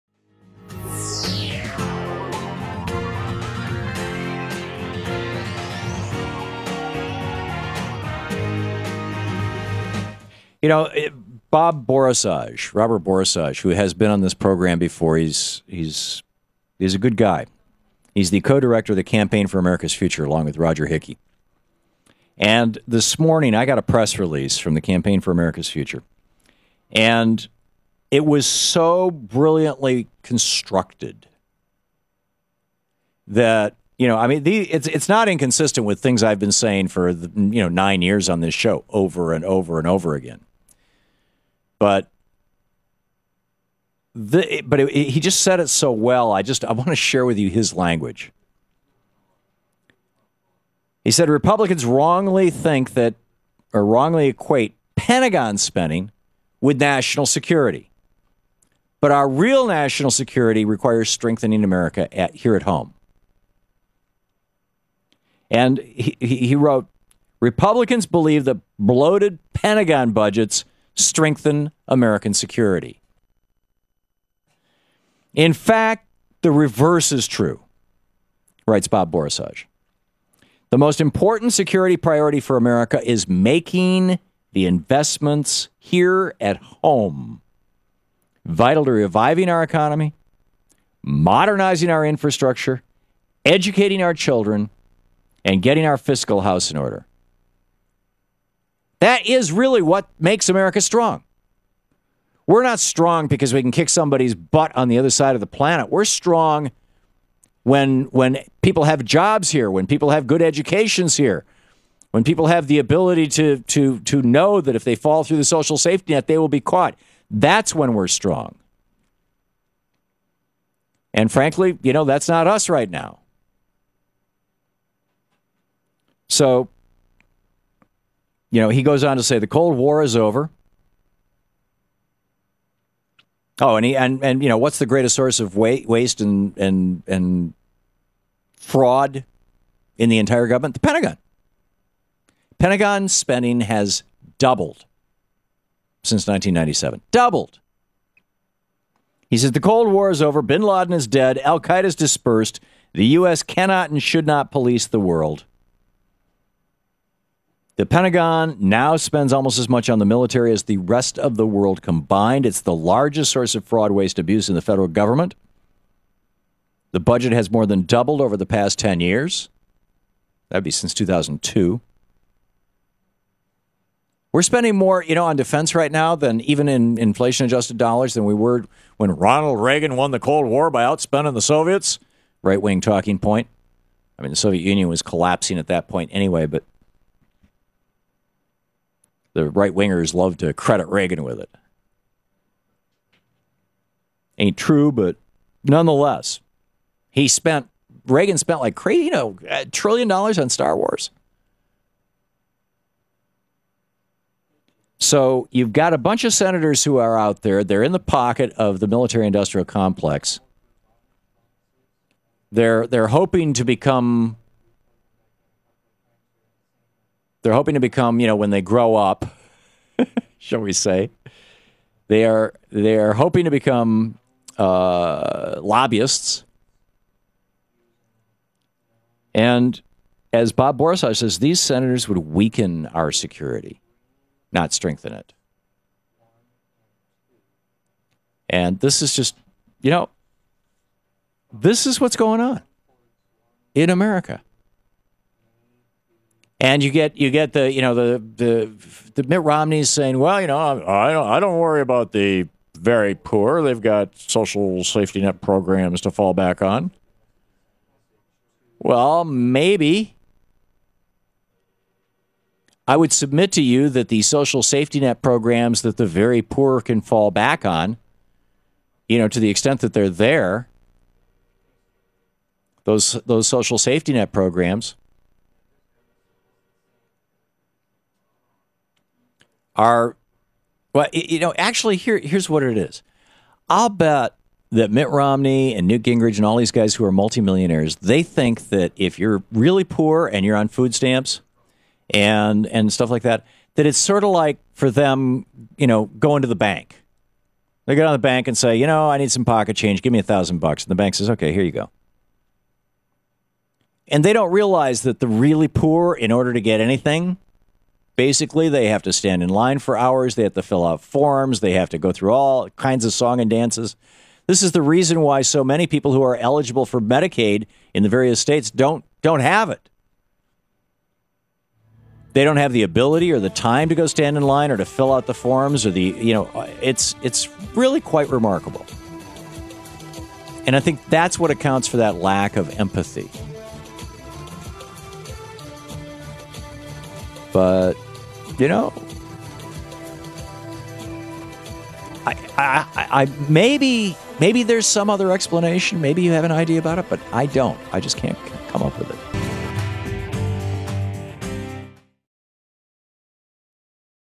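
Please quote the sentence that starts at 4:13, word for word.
They've got social safety net programs to fall back on.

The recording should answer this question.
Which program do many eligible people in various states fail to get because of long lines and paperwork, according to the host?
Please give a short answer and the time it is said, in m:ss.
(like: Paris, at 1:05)
Medicaid, at 5:17.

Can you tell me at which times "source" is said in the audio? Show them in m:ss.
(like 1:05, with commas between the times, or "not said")
2:15, 2:43.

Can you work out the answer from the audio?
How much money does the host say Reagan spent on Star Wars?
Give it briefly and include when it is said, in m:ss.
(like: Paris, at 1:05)
a trillion dollars, at 3:19.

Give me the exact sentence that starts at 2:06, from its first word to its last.
So you know, he goes on to say the Cold War is over.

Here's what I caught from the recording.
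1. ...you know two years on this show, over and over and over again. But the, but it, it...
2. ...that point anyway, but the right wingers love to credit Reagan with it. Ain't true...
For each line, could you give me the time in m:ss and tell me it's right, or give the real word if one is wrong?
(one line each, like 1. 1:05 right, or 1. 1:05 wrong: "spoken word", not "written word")
1. 0:37 wrong: "nine", not "two"
2. 3:05 right.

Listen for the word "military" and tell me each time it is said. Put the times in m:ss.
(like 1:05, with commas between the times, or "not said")
2:40, 3:28.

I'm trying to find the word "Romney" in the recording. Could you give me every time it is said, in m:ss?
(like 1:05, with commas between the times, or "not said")
4:09, 4:45.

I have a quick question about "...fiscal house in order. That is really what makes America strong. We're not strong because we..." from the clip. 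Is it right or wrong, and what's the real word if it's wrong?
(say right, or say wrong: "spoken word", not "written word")
right.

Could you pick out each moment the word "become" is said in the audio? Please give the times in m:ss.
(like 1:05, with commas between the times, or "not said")
3:33, 3:37, 3:43.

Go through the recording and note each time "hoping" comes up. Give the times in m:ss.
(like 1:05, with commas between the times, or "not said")
3:33, 3:37, 3:43.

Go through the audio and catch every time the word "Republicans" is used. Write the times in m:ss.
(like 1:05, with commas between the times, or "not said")
0:51, 1:07.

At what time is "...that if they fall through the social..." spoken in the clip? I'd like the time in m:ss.
1:54.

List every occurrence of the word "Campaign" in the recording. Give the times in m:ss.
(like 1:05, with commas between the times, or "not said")
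0:19, 0:24.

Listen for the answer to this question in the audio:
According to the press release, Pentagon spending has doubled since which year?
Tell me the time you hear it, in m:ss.
2:26.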